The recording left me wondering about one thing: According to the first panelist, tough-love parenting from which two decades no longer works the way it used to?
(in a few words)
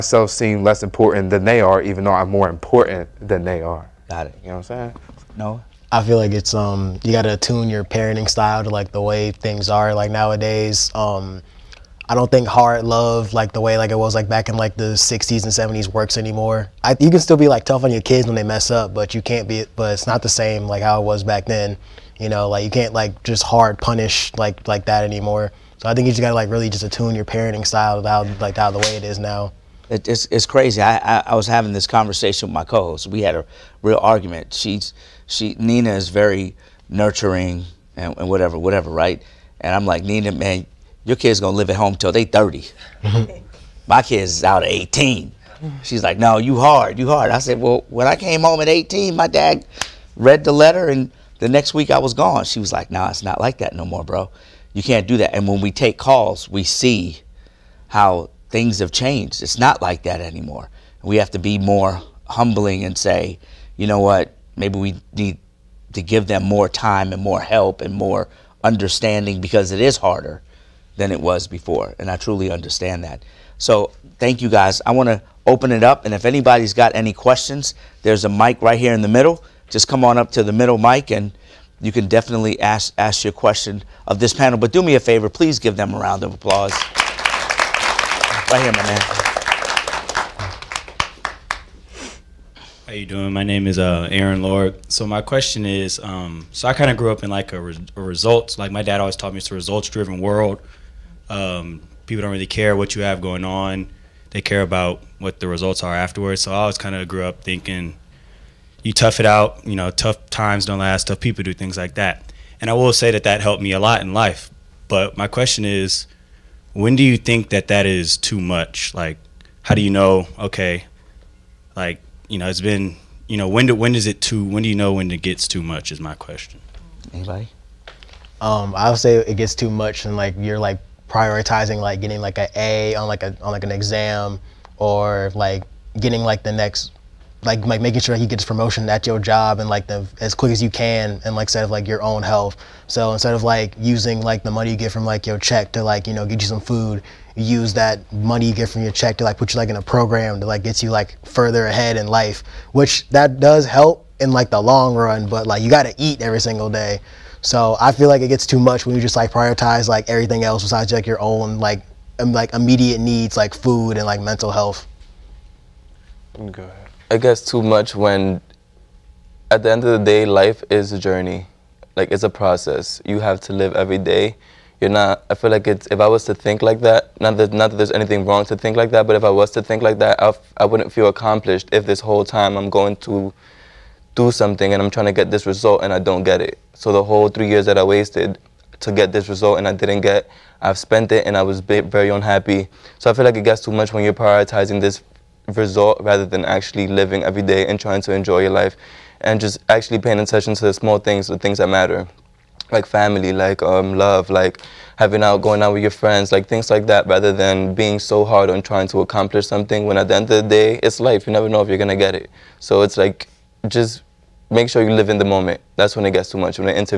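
60s and 70s.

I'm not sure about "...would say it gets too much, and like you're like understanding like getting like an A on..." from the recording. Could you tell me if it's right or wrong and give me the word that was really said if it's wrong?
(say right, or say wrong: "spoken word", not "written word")
wrong: "prioritizing", not "understanding".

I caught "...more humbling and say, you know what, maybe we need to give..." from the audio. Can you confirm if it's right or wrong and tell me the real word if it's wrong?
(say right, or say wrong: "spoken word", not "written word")
right.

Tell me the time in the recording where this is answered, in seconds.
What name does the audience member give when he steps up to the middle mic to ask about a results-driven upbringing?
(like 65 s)
94 s.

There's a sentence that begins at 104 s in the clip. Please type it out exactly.
They care about what the results are afterwards.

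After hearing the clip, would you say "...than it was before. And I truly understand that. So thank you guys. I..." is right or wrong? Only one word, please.
right.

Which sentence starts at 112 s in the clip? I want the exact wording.
And I will say that that helped me a lot in life.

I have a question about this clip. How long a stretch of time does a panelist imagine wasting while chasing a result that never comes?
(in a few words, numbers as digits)
3 years.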